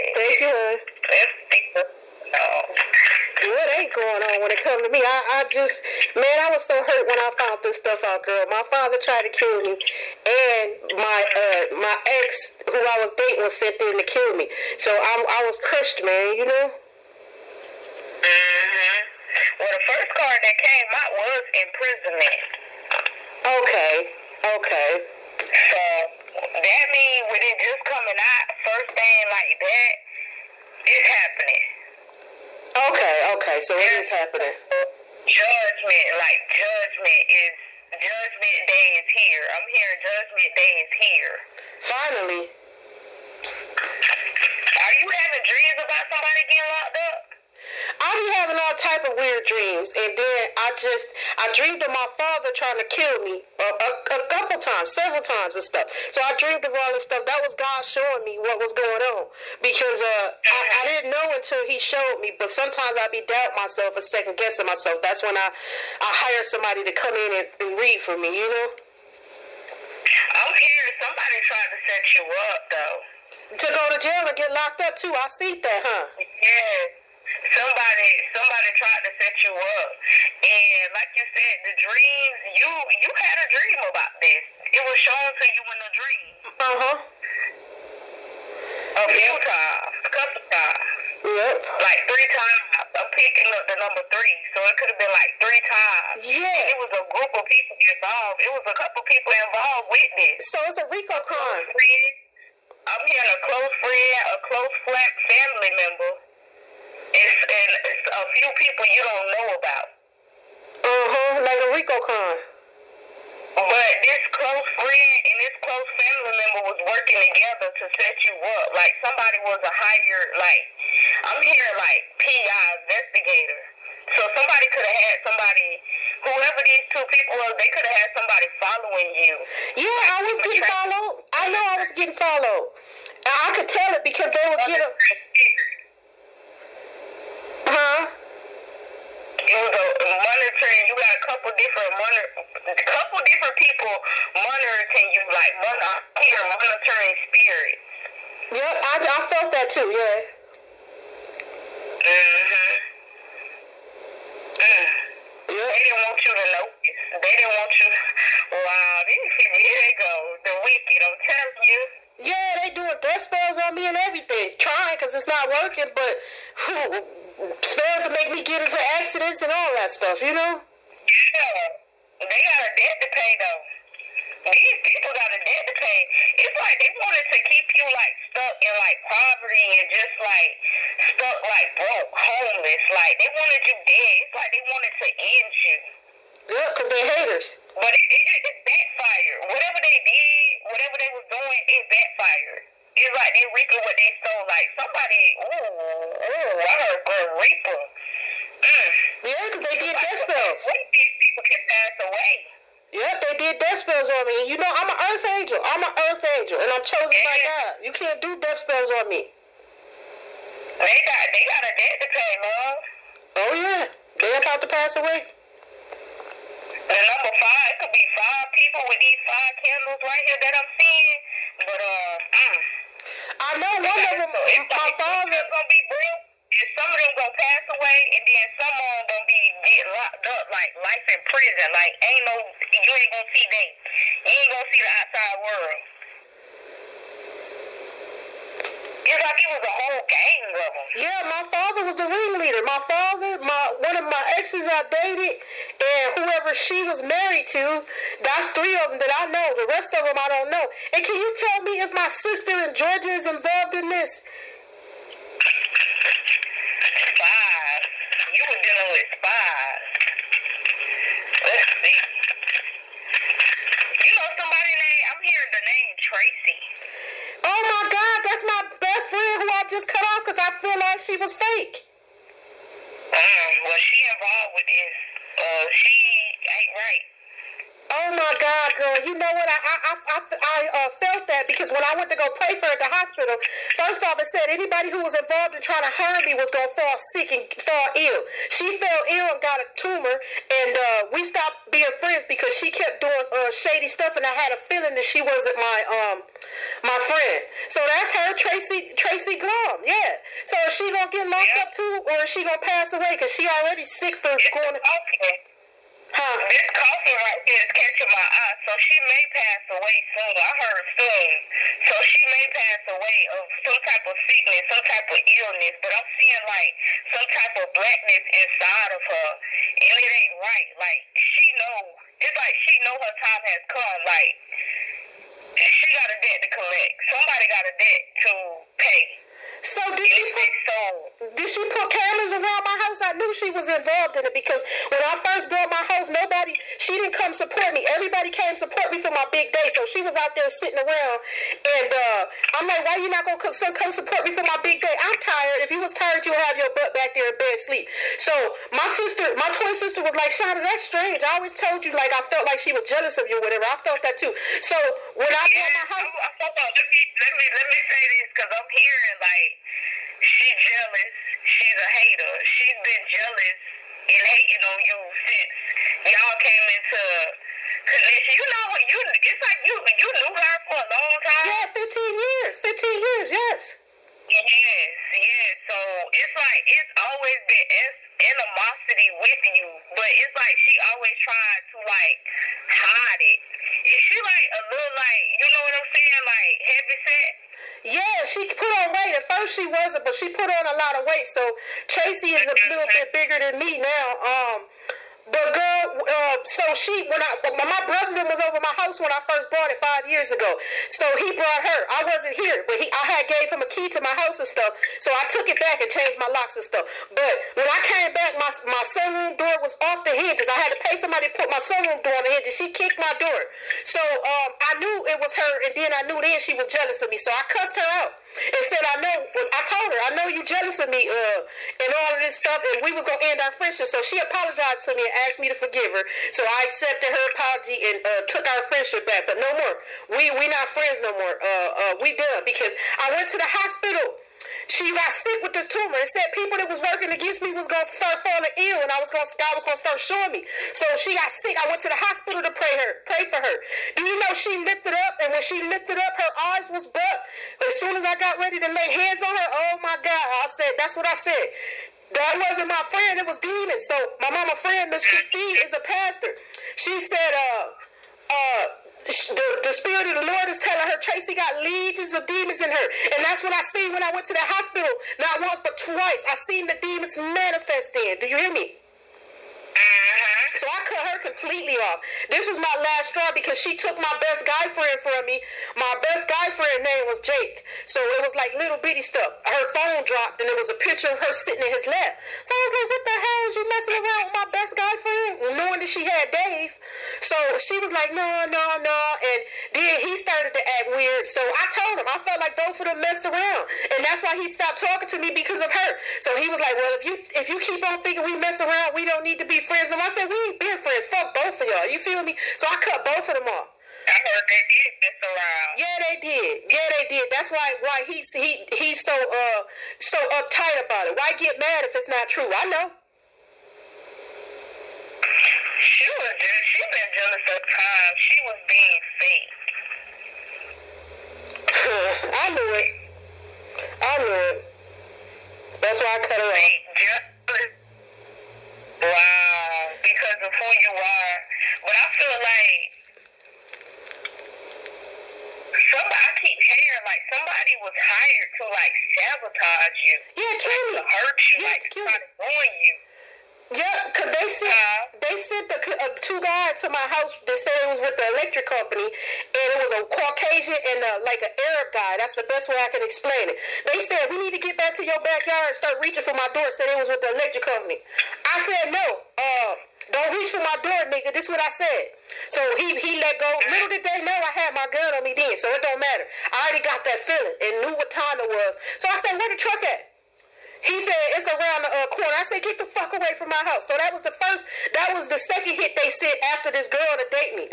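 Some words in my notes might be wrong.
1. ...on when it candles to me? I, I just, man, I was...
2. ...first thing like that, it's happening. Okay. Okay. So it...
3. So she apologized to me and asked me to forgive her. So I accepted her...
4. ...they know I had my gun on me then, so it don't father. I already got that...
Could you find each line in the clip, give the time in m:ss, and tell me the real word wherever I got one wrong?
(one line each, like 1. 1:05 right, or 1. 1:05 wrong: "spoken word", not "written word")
1. 0:04 wrong: "comes", not "candles"
2. 0:28 right
3. 7:03 right
4. 9:24 wrong: "matter", not "father".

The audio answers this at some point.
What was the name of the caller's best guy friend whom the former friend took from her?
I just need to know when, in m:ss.
7:57.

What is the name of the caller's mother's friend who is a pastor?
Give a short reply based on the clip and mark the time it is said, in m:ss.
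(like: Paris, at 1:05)
Miss Christine, at 7:34.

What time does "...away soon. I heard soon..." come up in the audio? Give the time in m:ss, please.
5:09.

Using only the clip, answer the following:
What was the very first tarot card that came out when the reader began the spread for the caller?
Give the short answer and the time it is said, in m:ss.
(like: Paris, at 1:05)
Imprisonment, at 0:21.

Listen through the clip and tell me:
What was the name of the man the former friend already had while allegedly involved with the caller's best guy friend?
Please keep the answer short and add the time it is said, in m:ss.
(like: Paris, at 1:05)
Dave, at 8:06.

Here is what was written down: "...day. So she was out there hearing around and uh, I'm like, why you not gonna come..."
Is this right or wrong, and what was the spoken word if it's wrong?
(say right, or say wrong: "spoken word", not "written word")
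wrong: "sitting", not "hearing".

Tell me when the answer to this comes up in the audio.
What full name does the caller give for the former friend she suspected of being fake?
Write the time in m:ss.
4:58.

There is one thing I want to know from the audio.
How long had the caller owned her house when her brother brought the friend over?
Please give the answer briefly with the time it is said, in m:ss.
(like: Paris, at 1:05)
5 years, at 6:39.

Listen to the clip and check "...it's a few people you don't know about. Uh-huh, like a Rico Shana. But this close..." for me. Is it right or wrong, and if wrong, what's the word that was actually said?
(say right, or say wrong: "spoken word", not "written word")
wrong: "Con", not "Shana".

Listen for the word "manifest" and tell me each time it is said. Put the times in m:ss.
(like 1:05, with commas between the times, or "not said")
7:47.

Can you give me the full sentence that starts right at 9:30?
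He said it's around the uh, corner.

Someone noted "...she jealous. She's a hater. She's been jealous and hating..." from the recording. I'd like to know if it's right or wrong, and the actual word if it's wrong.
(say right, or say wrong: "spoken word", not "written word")
right.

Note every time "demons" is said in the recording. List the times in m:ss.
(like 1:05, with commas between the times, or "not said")
7:33, 7:42, 7:46.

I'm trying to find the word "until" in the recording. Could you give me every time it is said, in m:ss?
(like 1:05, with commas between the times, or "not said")
1:01.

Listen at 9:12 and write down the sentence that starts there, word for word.
That's the best way I can explain it.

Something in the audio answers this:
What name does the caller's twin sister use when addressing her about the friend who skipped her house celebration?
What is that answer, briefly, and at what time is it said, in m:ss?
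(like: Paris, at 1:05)
Shana, at 5:50.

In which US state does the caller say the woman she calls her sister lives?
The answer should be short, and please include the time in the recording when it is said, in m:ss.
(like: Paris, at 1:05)
Georgia, at 4:12.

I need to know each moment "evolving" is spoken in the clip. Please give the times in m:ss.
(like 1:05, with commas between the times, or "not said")
not said.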